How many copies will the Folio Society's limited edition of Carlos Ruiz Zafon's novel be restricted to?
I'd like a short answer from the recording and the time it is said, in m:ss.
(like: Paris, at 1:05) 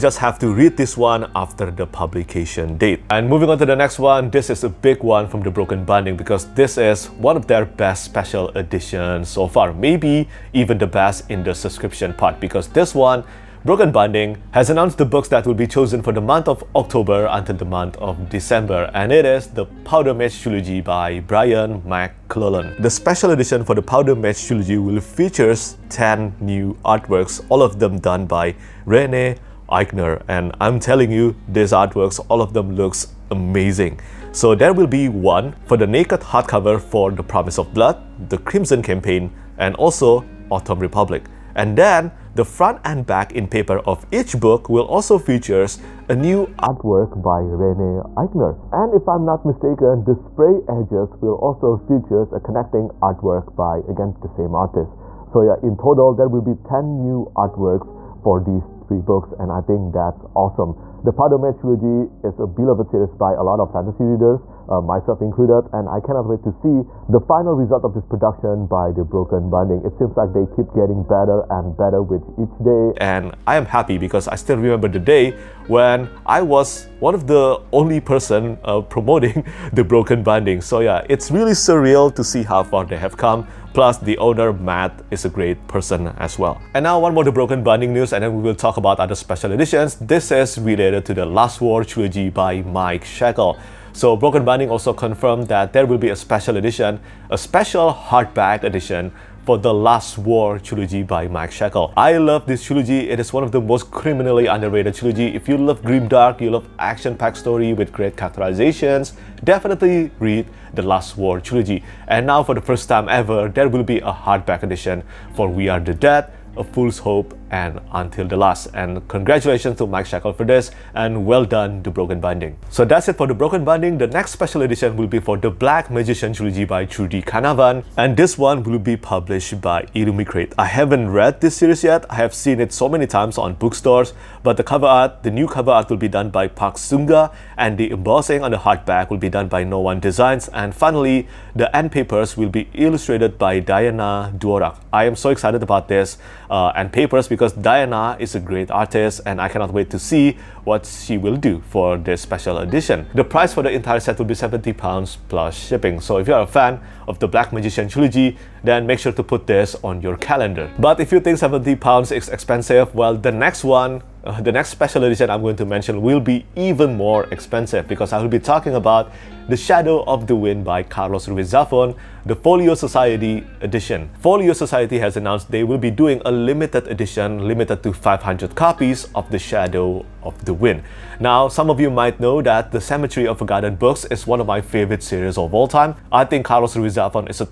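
500, at 2:57.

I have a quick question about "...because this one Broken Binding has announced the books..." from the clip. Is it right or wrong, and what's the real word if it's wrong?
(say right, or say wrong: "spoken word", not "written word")
right.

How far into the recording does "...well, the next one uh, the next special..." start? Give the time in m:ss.
2:42.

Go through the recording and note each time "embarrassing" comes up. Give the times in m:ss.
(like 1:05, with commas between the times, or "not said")
not said.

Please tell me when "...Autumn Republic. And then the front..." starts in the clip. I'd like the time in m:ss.
0:40.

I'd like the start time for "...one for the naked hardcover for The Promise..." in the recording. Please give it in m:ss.
0:35.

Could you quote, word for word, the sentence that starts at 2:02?
So that's it for the Broken Binding.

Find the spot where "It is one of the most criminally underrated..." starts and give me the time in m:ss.
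1:43.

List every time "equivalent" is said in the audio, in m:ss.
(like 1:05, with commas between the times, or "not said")
not said.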